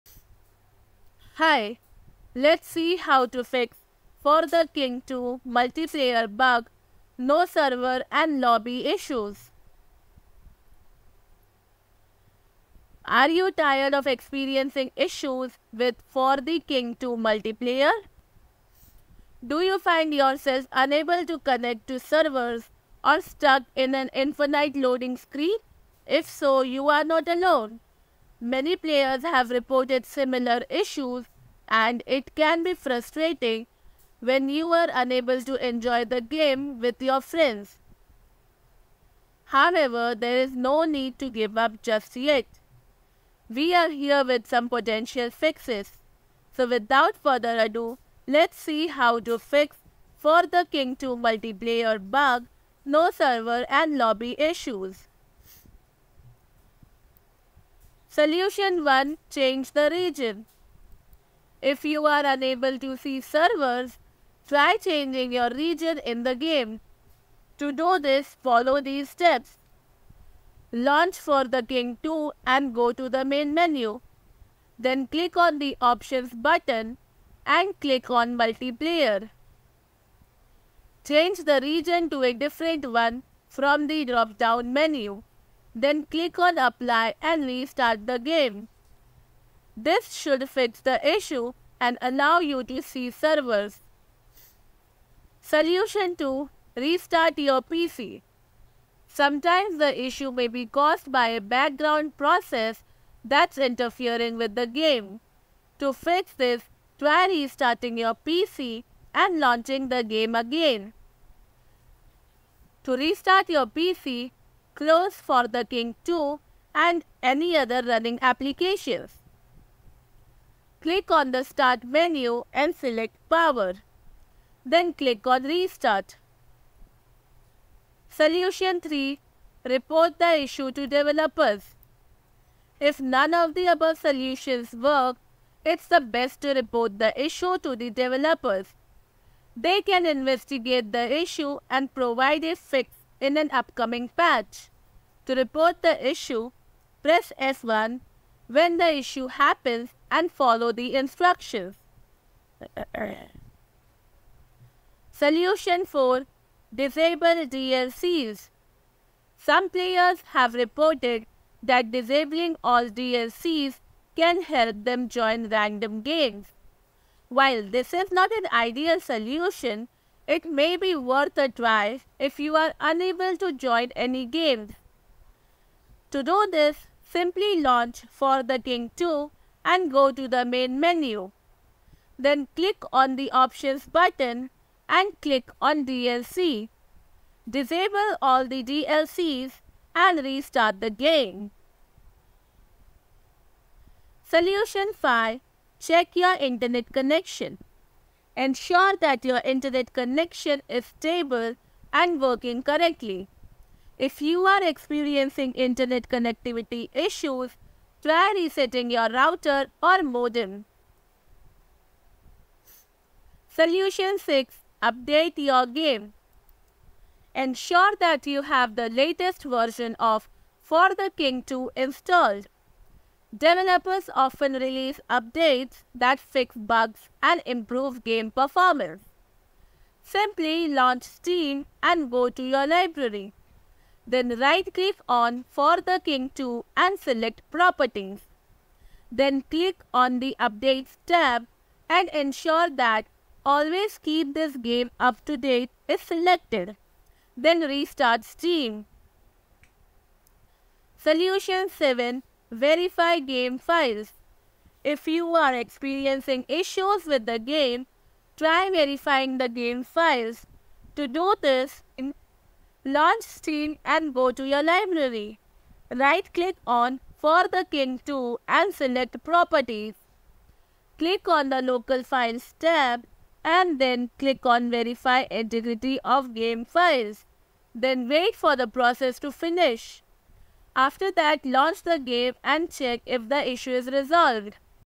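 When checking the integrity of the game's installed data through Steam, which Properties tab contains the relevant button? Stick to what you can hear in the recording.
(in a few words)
Local Files.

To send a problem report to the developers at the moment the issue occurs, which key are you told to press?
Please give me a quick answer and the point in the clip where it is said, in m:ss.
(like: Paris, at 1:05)
S1, at 2:27.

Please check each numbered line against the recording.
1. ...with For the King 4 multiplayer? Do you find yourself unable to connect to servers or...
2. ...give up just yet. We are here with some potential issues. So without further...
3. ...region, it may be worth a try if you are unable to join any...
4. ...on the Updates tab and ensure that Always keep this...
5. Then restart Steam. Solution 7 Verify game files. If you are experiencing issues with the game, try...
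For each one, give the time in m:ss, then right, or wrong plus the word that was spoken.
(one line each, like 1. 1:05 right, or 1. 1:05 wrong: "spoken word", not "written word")
1. 0:15 wrong: "2", not "4"
2. 0:41 wrong: "fixes", not "issues"
3. 2:48 wrong: "solution", not "region"
4. 3:59 right
5. 4:07 right.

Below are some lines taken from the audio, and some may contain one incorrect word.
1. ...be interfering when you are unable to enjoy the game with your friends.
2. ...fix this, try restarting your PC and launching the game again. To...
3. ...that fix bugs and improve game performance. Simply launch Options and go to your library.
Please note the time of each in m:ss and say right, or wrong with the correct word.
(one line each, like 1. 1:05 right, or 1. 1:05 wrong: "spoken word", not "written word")
1. 0:32 wrong: "frustrating", not "interfering"
2. 1:45 right
3. 3:45 wrong: "Steam", not "Options".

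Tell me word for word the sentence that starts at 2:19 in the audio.
They can investigate the issue and provide a fix in an upcoming patch.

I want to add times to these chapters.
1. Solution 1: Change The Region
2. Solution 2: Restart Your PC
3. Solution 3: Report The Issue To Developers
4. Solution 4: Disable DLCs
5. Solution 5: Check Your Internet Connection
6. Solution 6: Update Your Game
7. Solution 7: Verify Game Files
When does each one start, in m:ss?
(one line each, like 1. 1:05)
1. 0:57
2. 1:35
3. 2:07
4. 2:34
5. 3:13
6. 3:33
7. 4:10.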